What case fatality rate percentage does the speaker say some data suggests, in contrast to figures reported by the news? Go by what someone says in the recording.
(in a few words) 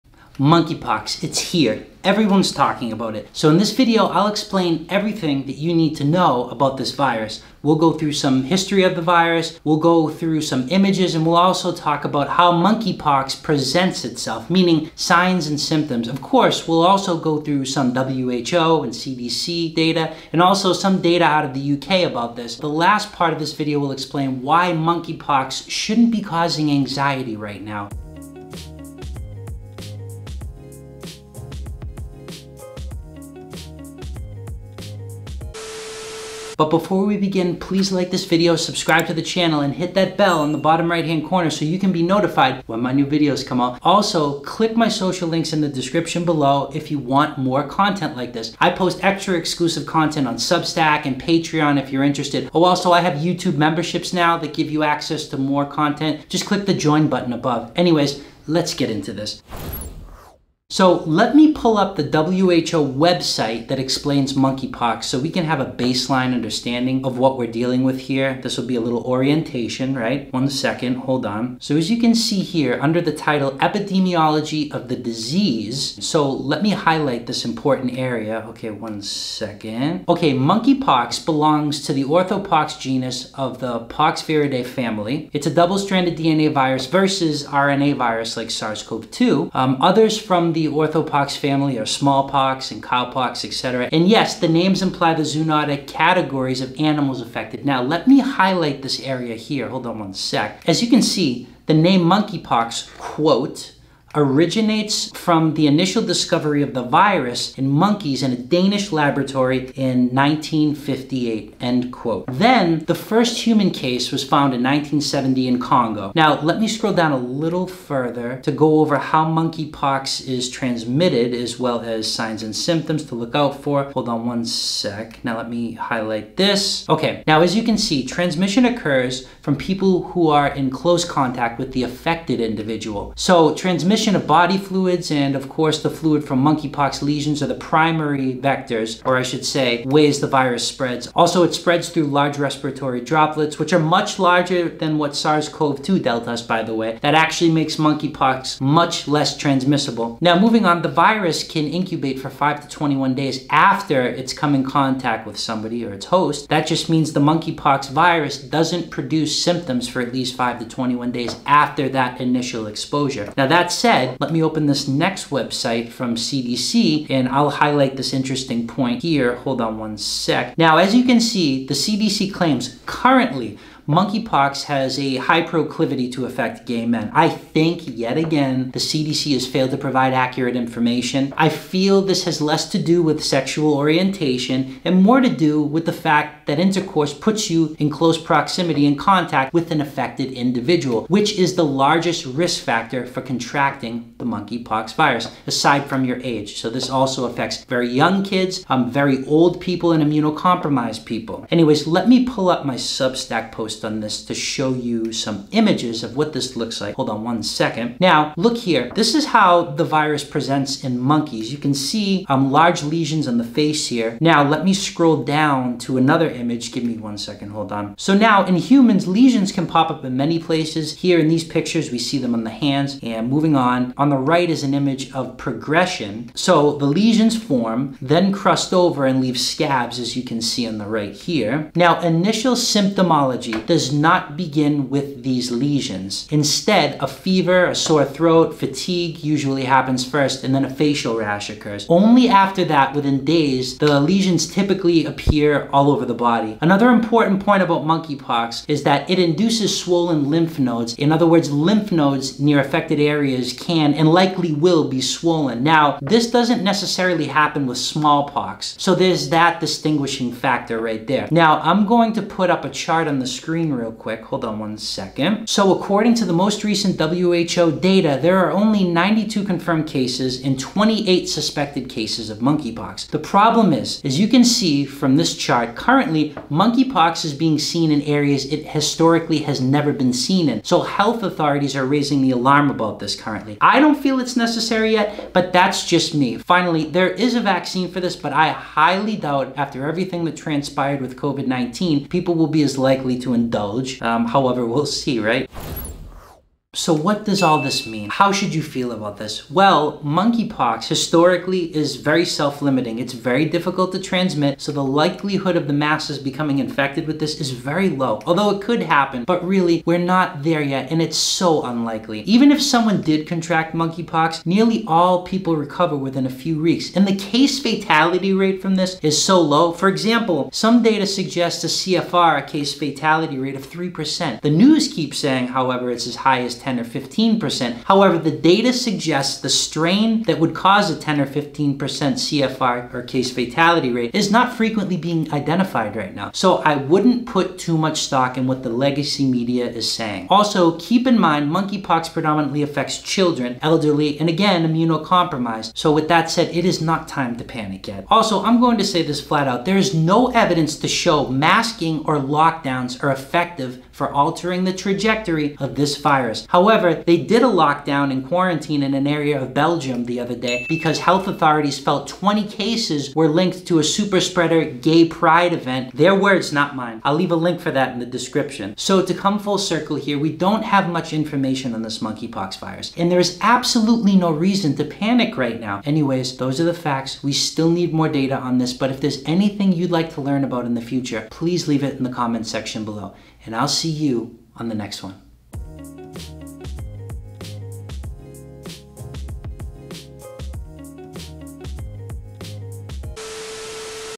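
3%.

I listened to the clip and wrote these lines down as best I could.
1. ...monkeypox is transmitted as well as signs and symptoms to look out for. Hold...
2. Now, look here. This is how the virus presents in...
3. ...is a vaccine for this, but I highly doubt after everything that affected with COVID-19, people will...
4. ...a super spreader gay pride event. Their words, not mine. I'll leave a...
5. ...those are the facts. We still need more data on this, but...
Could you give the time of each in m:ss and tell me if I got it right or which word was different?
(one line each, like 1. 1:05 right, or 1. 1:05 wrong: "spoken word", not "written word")
1. 1:59 right
2. 3:27 right
3. 4:47 wrong: "transpired", not "affected"
4. 6:03 right
5. 6:16 right.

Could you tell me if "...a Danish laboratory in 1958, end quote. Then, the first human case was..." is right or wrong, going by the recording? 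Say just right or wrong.
right.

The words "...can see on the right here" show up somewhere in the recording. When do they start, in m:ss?
3:50.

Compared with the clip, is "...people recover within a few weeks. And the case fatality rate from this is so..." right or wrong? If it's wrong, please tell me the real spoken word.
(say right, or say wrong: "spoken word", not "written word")
right.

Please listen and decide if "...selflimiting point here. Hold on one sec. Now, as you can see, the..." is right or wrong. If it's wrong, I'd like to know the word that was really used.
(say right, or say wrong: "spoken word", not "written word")
wrong: "interesting", not "selflimiting".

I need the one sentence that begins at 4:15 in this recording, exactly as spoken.
Now, this doesn't necessarily happen with smallpox, so there's that distinguishing factor right there.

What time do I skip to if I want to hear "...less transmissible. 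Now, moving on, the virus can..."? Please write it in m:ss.
2:29.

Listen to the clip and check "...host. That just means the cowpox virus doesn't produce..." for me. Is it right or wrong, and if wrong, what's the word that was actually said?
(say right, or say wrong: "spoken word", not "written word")
wrong: "monkeypox", not "cowpox".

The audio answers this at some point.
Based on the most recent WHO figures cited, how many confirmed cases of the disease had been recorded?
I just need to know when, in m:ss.
4:28.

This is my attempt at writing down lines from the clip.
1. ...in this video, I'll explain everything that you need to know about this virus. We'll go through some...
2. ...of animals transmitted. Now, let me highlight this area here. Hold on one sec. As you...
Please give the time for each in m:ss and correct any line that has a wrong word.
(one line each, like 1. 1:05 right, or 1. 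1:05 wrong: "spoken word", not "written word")
1. 0:03 right
2. 1:36 wrong: "affected", not "transmitted".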